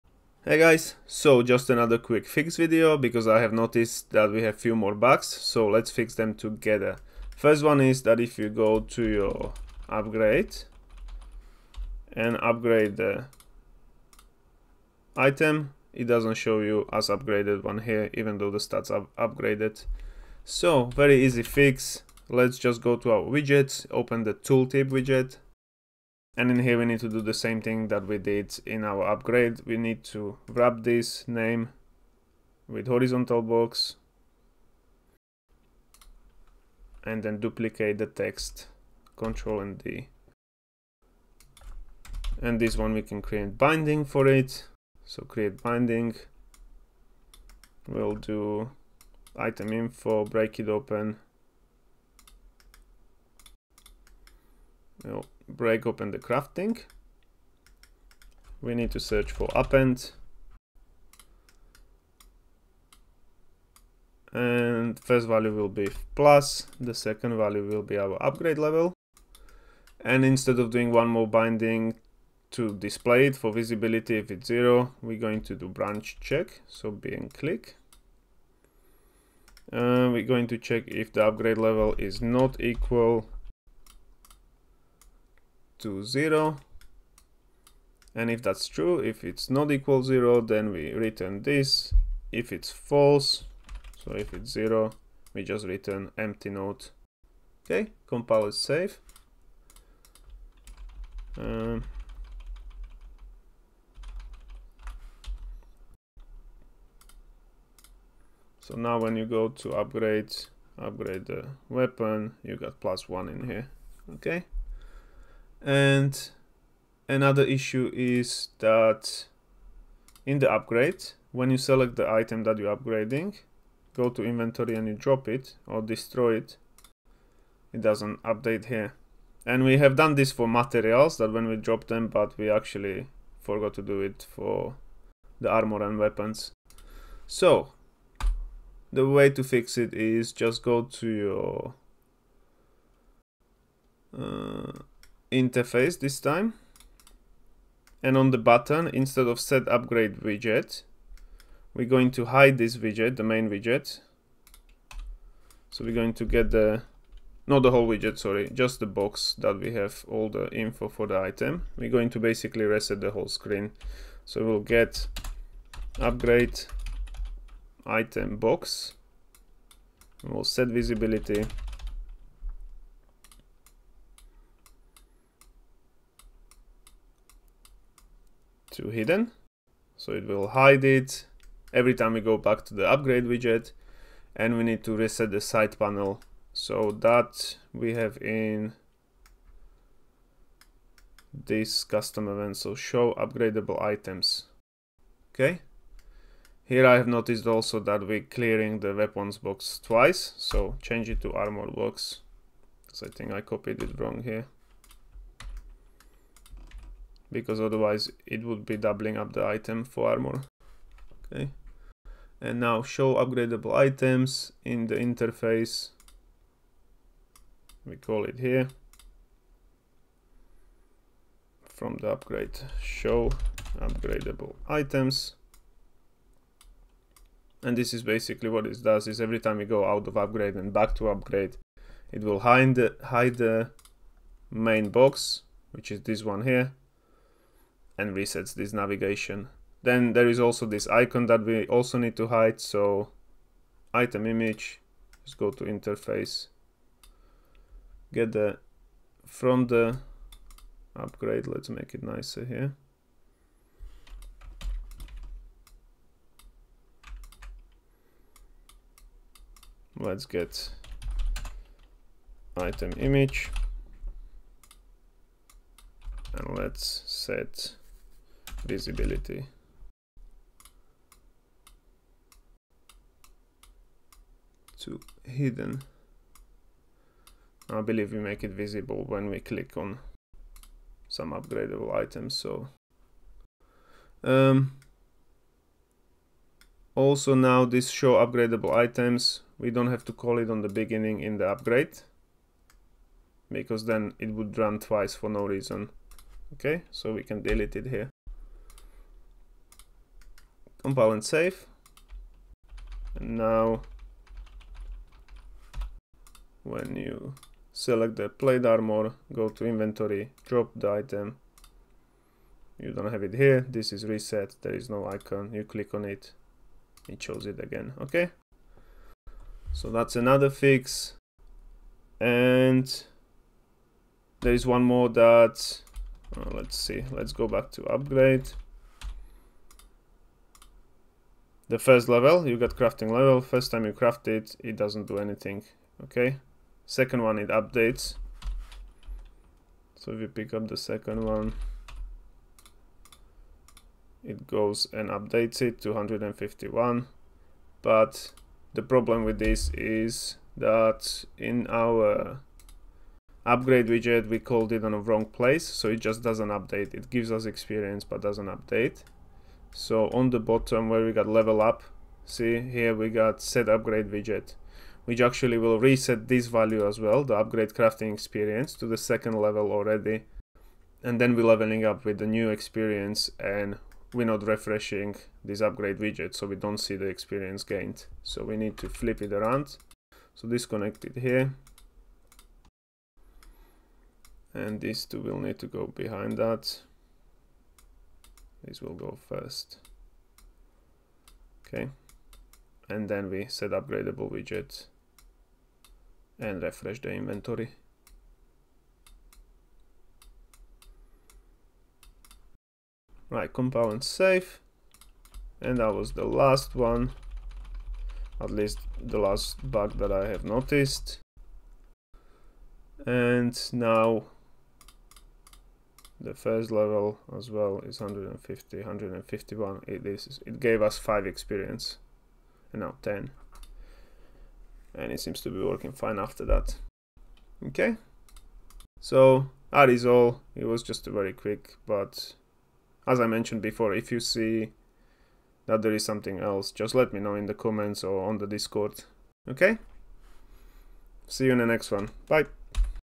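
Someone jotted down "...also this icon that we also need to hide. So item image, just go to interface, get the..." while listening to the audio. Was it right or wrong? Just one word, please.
right.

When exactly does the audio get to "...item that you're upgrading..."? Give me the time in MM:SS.
02:02.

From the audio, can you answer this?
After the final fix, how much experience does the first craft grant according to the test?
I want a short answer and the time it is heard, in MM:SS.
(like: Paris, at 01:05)
5, at 07:00.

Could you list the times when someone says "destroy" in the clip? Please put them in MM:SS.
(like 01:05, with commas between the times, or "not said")
02:05.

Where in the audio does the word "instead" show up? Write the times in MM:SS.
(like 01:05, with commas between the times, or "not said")
01:10, 02:28.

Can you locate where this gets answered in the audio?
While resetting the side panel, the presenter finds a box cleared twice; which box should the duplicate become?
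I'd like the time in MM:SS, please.
03:21.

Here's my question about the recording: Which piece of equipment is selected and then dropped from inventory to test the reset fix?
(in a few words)
plate armor.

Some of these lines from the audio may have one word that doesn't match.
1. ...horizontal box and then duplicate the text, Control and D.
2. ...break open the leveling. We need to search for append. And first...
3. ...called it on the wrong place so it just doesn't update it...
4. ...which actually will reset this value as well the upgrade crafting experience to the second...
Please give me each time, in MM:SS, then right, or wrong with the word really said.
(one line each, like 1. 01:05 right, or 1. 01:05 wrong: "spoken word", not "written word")
1. 00:32 right
2. 00:55 wrong: "crafting", not "leveling"
3. 05:54 right
4. 06:05 right.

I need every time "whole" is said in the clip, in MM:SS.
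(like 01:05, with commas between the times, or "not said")
02:37, 02:43.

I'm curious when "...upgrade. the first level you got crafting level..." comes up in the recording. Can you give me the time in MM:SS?
05:27.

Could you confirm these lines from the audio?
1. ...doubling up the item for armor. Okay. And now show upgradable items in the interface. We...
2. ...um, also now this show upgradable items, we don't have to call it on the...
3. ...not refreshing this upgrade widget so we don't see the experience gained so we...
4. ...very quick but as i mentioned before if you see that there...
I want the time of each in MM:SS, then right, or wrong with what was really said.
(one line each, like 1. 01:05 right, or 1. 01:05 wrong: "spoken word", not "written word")
1. 03:28 right
2. 04:44 right
3. 06:14 right
4. 07:11 right.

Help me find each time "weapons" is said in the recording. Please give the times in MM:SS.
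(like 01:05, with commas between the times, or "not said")
01:51, 02:15, 03:18.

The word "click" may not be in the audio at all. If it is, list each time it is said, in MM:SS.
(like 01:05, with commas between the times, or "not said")
01:17, 04:39, 05:15.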